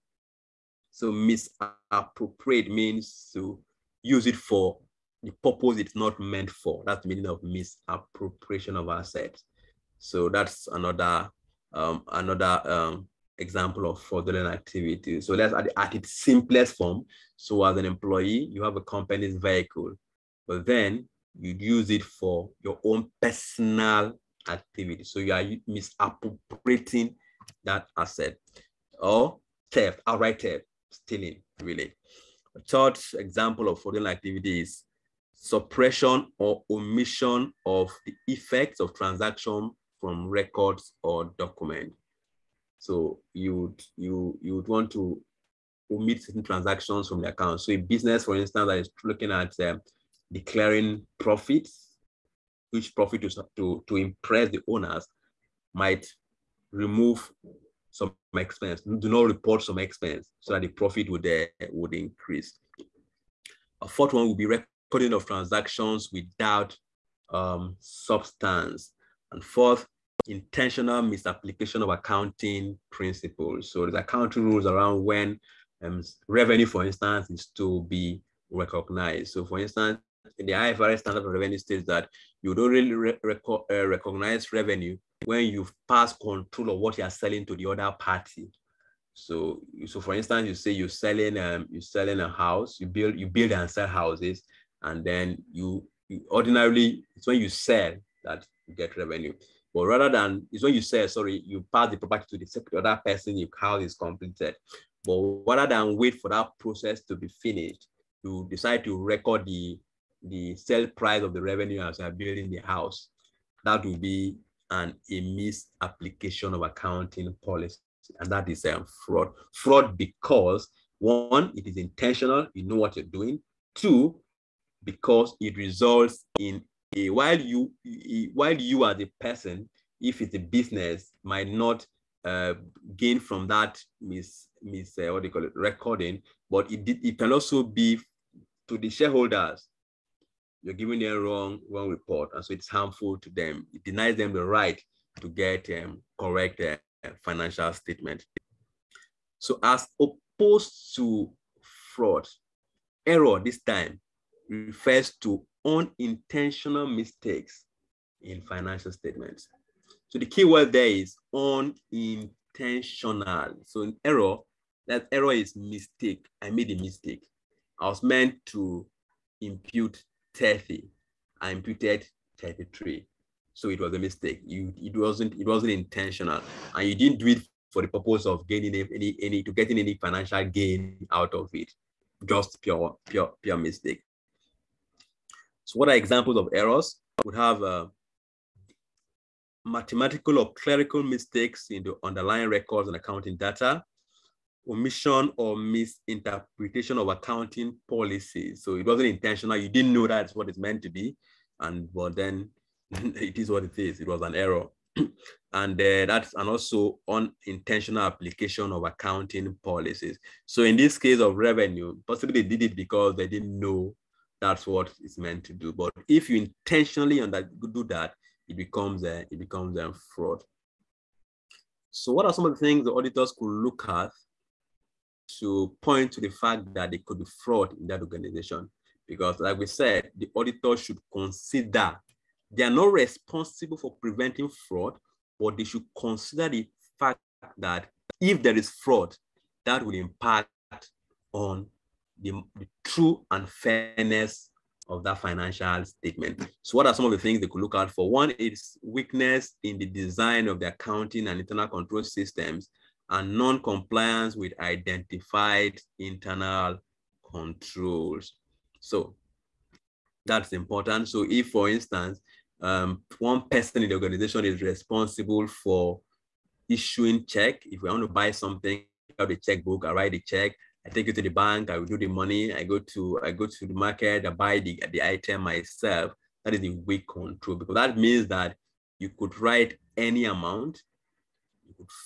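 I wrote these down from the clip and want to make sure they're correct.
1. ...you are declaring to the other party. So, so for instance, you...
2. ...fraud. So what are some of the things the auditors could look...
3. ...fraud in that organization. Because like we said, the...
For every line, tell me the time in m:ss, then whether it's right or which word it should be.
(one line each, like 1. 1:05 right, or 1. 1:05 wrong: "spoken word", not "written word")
1. 1:26 wrong: "selling", not "declaring"
2. 3:40 right
3. 3:47 right.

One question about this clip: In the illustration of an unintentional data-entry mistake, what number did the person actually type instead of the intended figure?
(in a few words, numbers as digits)
33.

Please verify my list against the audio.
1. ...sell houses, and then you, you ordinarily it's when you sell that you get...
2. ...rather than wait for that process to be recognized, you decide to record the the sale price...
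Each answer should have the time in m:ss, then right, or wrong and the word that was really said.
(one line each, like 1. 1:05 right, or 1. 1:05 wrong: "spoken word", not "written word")
1. 1:33 right
2. 1:45 wrong: "finished", not "recognized".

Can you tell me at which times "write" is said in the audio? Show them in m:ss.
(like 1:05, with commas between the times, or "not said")
4:29, 4:39.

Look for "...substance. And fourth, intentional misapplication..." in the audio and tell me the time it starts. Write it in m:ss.
1:07.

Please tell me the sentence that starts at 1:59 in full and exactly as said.
Fraud because one, it is intentional, you know what you're doing.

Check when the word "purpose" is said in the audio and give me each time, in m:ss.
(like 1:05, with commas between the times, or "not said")
0:05, 2:57.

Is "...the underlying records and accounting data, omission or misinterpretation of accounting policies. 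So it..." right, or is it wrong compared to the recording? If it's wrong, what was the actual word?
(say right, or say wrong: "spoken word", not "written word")
right.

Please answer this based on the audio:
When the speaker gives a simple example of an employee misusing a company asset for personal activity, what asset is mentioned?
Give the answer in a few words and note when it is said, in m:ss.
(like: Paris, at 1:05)
company's vehicle, at 0:18.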